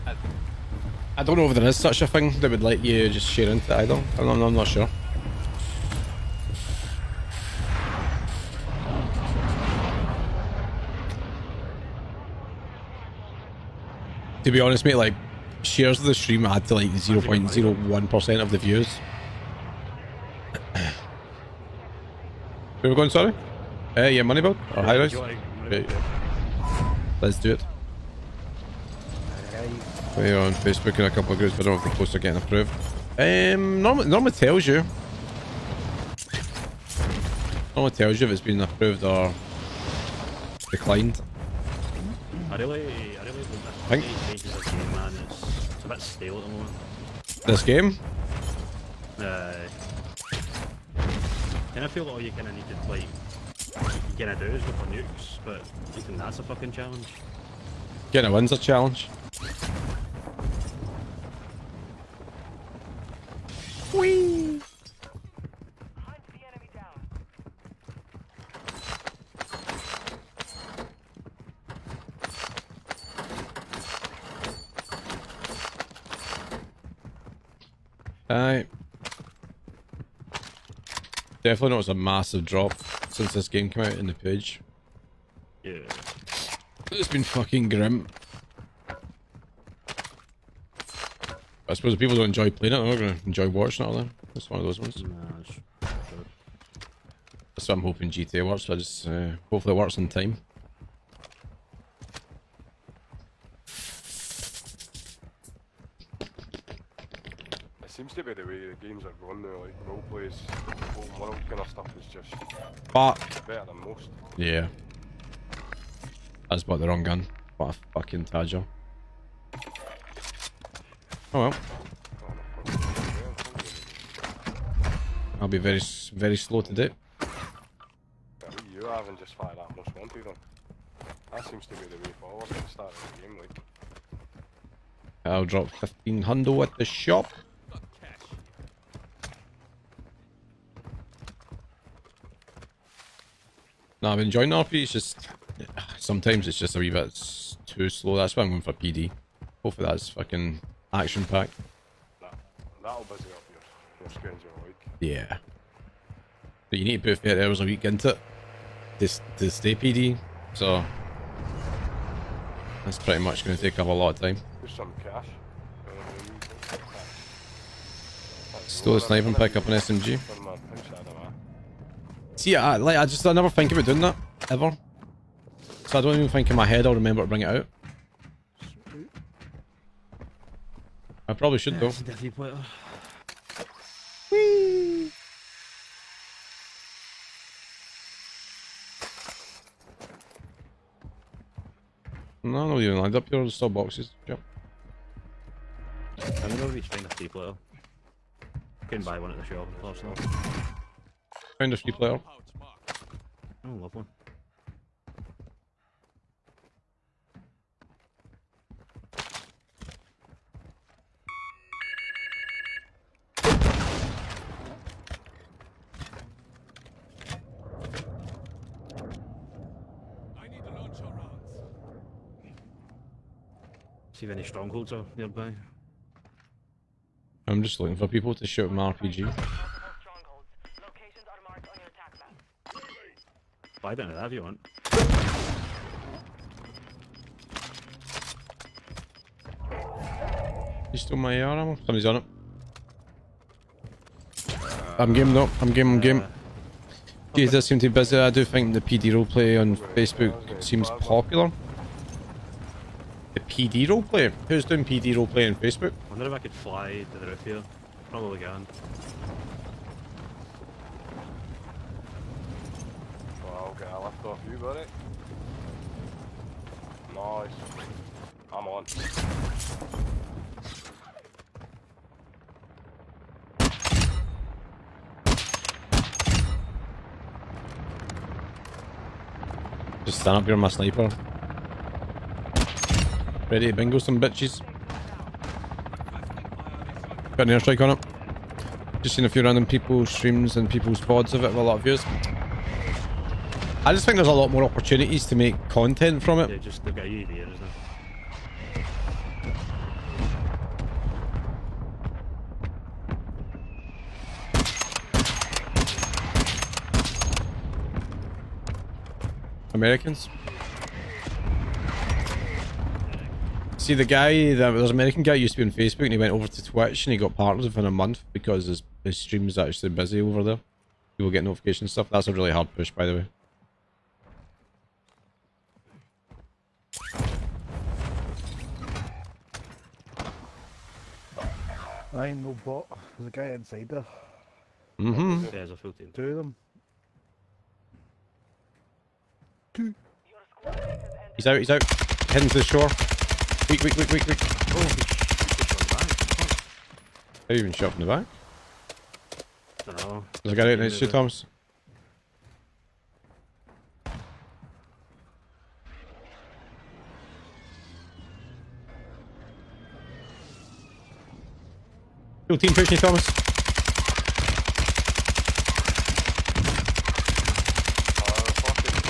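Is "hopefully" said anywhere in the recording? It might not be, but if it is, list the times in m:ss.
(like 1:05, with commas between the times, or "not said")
1:39, 2:29.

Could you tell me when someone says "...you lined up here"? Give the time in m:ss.
3:12.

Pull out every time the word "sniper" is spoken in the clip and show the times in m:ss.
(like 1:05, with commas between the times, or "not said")
2:48, 4:40.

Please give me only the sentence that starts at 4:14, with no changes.
Who's doing PD roleplay on Facebook?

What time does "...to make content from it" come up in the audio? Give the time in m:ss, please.
4:55.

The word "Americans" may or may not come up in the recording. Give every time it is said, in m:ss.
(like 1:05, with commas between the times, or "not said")
5:09, 5:14.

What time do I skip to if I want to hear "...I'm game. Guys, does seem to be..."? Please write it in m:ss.
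4:05.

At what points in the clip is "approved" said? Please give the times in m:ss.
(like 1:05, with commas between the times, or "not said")
0:32, 0:38.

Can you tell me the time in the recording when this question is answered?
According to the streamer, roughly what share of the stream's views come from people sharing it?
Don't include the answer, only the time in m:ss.
0:16.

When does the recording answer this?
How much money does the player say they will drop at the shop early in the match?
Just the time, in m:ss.
2:15.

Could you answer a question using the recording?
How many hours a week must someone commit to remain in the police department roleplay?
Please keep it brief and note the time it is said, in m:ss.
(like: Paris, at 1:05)
30 hours, at 2:37.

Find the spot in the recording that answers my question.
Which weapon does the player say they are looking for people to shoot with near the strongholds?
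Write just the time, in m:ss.
3:48.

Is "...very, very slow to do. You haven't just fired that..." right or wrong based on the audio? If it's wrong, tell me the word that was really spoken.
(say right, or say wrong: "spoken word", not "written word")
right.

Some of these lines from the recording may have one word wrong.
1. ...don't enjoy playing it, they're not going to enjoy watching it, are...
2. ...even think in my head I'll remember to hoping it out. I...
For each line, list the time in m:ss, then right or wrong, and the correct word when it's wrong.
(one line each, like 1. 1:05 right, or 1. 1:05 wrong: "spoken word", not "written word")
1. 1:32 right
2. 2:56 wrong: "bring", not "hoping".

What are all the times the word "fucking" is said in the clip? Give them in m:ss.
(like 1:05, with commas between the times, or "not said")
0:56, 1:27, 1:57, 2:30.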